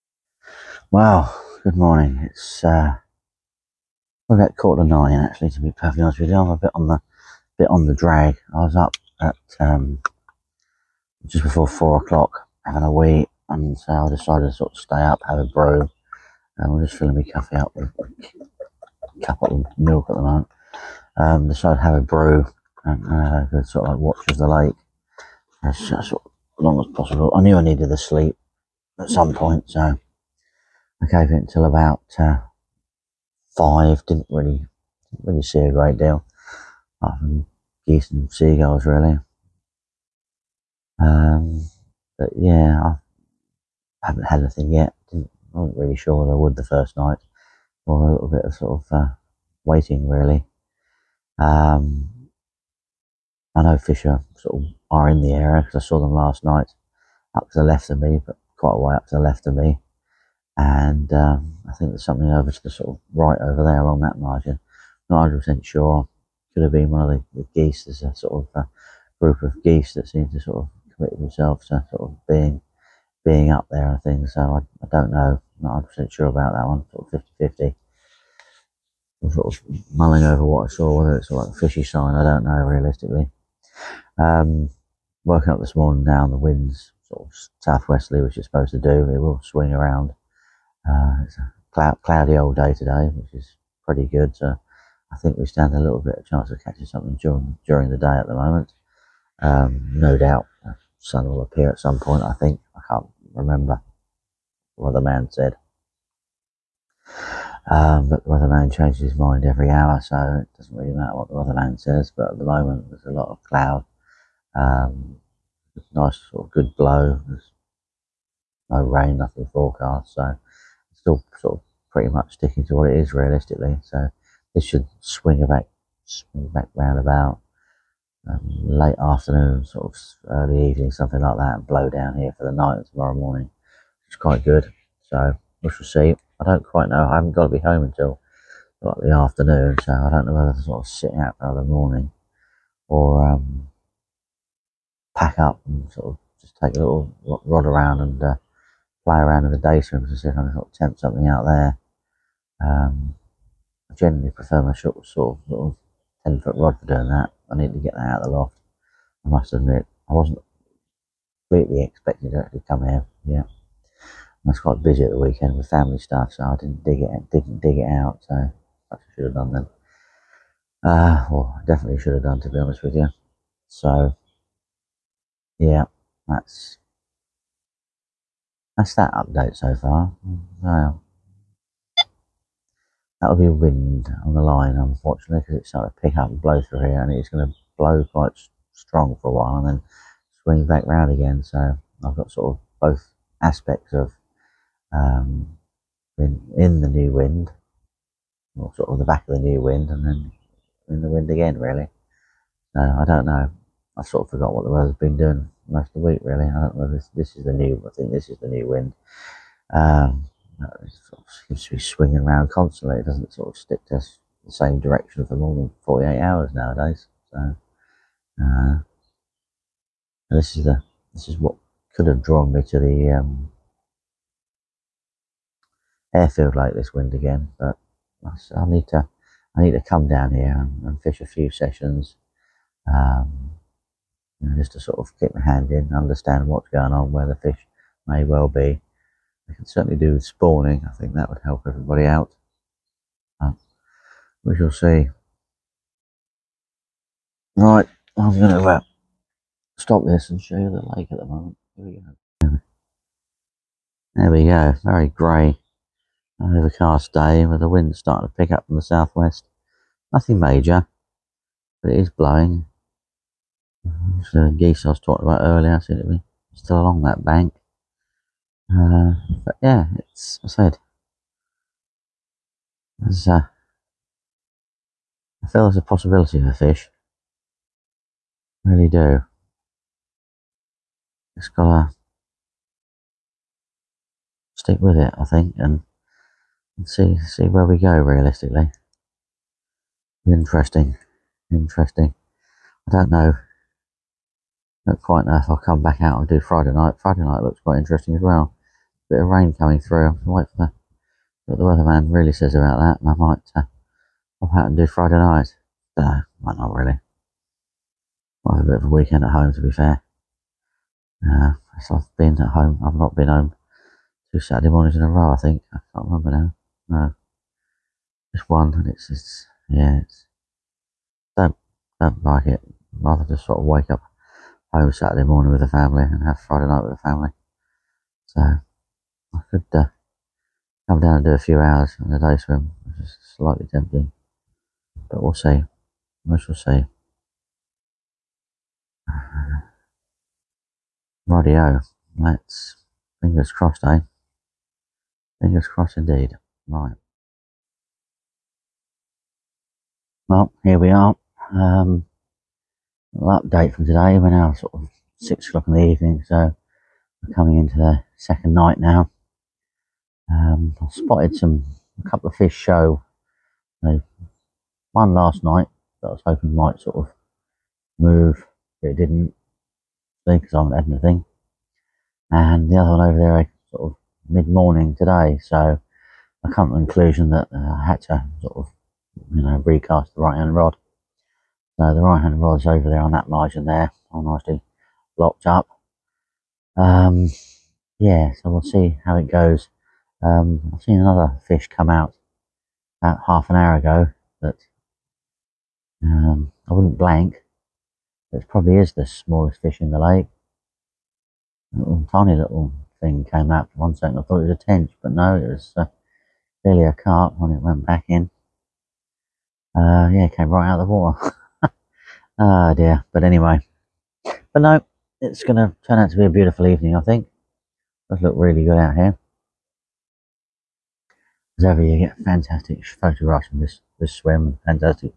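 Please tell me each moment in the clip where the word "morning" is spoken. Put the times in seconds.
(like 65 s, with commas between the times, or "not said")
1 s, 85 s, 133 s, 141 s, 314 s, 325 s, 374 s.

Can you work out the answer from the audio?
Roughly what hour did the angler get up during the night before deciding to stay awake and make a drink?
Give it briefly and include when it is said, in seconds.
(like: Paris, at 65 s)
just before 4, at 11 s.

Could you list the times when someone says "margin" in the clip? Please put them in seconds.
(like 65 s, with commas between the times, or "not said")
64 s, 383 s.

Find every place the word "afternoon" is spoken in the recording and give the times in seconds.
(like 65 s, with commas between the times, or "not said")
128 s, 139 s.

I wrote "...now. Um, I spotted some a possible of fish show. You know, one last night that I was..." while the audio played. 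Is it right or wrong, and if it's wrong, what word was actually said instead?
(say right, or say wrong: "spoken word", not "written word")
wrong: "couple", not "possible".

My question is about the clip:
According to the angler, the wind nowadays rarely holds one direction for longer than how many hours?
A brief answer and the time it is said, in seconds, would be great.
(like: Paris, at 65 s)
48, at 215 s.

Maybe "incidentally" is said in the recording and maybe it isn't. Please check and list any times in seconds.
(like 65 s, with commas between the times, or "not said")
not said.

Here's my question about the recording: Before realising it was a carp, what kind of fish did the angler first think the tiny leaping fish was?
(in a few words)
tench.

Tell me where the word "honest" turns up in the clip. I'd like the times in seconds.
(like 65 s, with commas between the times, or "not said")
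6 s, 172 s.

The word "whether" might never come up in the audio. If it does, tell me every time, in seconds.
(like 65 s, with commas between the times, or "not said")
80 s, 140 s.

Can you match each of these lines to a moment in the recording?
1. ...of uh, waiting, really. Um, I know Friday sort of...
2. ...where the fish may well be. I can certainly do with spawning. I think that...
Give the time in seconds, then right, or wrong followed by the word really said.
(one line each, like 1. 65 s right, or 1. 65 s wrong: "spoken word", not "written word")
1. 48 s wrong: "Fisher", not "Friday"
2. 237 s right.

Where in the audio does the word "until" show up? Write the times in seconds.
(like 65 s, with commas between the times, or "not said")
31 s, 137 s.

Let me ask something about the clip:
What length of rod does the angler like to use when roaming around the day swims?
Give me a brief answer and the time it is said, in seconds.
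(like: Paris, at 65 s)
10 foot, at 156 s.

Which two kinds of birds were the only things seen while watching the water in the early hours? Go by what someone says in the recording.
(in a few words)
geese and seagulls.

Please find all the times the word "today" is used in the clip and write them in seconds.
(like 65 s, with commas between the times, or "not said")
92 s, 353 s, 374 s.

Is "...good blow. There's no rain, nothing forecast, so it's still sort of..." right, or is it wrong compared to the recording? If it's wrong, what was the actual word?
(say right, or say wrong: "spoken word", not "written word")
right.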